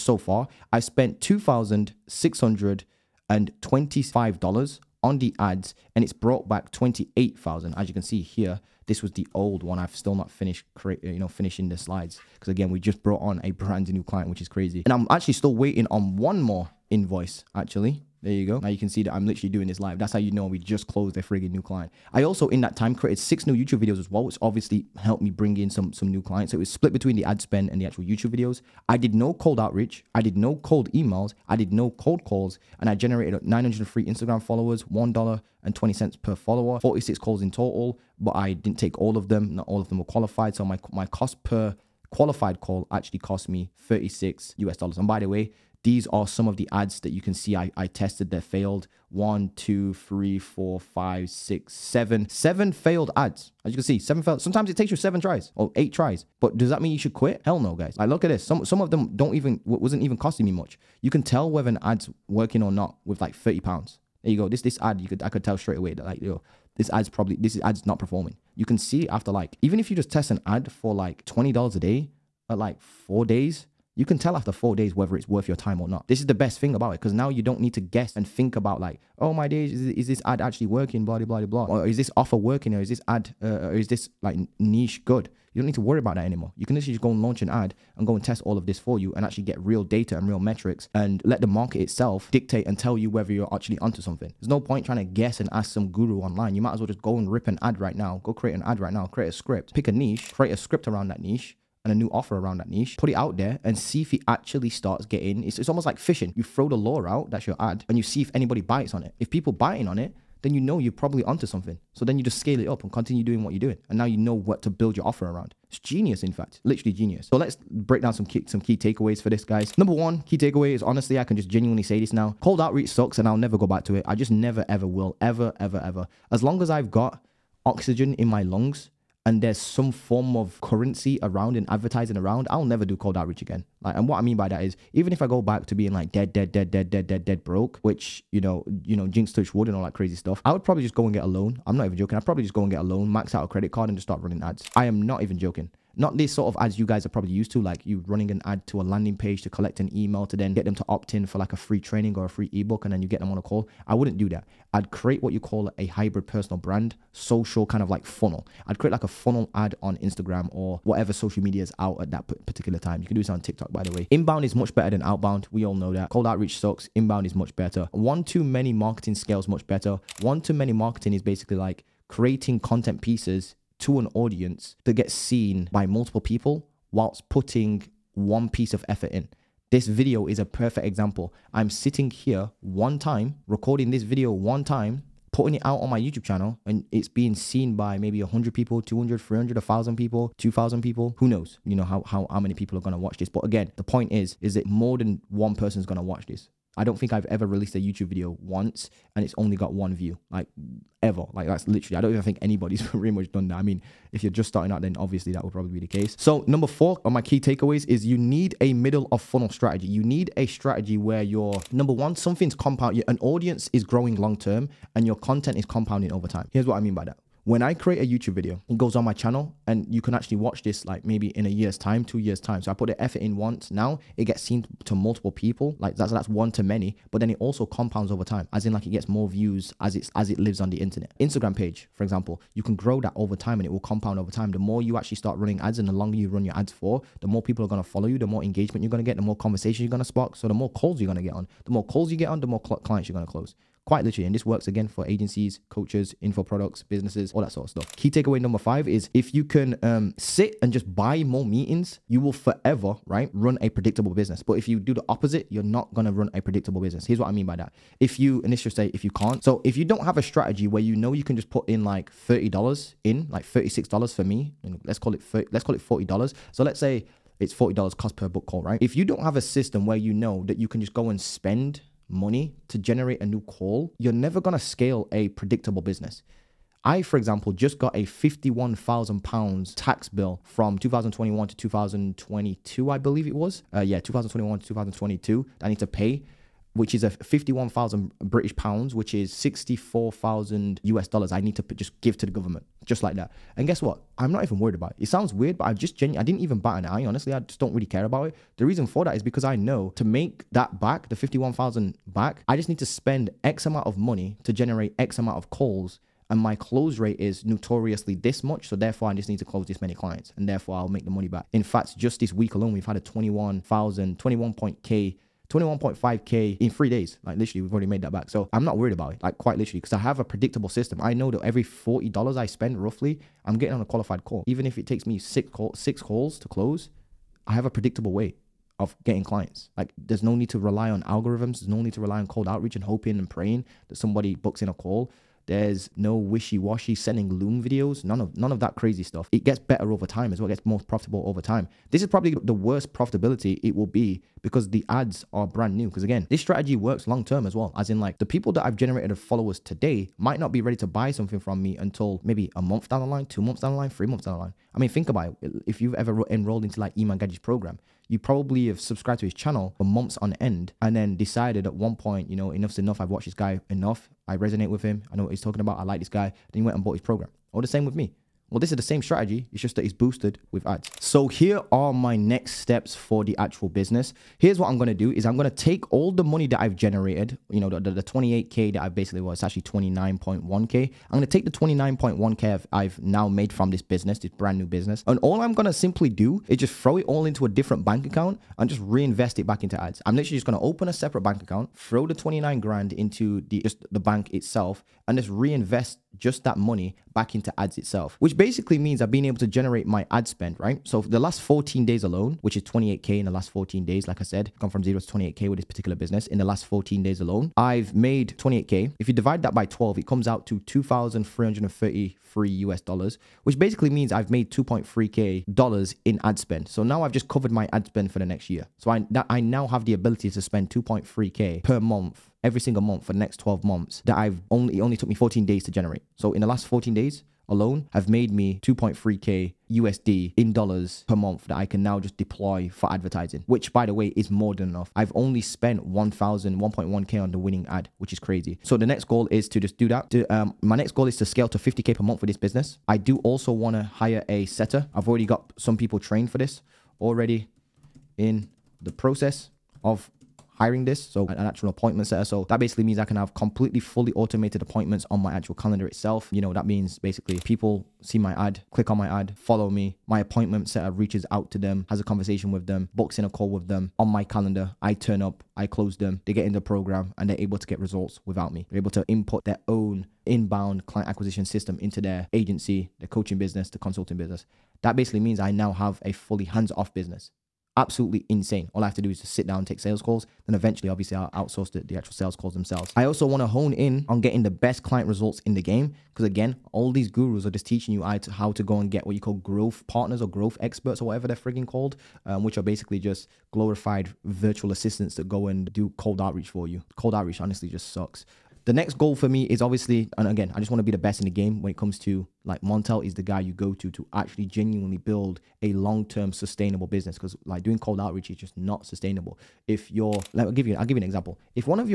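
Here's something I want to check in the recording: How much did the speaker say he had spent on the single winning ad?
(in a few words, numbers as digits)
1.1k.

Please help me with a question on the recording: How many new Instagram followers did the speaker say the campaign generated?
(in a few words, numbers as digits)
903.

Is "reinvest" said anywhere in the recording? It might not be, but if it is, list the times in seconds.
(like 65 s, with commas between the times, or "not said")
388 s, 395 s.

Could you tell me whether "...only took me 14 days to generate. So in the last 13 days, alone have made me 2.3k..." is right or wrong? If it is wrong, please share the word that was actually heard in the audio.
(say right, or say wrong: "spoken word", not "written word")
wrong: "14", not "13".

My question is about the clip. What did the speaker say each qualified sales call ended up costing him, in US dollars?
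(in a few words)
$36.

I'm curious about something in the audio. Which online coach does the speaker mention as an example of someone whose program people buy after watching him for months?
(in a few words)
Iman Gadzhi.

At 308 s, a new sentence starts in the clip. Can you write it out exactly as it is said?
So therefore, I just need to close this many clients, and therefore I'll make the money back.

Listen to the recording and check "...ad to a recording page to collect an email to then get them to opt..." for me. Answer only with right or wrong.
wrong.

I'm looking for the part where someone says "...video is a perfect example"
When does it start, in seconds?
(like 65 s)
179 s.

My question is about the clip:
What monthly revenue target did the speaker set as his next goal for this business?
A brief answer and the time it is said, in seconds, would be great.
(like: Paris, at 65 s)
50k, at 441 s.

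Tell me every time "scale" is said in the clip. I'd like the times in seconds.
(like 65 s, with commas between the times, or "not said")
112 s, 169 s, 274 s, 441 s.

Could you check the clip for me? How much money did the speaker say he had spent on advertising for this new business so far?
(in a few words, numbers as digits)
$2,625.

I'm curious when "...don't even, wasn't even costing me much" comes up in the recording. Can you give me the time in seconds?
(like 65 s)
59 s.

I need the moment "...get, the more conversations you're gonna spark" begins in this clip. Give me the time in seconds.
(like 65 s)
239 s.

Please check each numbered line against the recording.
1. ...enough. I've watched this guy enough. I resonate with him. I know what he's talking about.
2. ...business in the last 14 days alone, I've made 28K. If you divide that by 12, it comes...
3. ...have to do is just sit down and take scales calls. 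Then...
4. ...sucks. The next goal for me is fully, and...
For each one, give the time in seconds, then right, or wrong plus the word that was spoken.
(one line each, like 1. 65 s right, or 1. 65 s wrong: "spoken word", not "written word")
1. 362 s right
2. 405 s right
3. 478 s wrong: "sales", not "scales"
4. 497 s wrong: "obviously", not "fully".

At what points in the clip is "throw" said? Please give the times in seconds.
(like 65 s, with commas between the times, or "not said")
106 s, 386 s, 391 s.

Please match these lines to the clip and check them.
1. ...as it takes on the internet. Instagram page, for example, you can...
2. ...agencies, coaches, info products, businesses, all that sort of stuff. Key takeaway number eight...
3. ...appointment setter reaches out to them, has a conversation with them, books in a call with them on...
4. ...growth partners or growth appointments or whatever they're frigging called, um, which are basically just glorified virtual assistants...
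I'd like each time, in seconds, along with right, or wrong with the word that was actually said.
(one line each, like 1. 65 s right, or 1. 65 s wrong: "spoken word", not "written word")
1. 230 s wrong: "lives", not "takes"
2. 245 s wrong: "five", not "eight"
3. 460 s right
4. 489 s wrong: "experts", not "appointments".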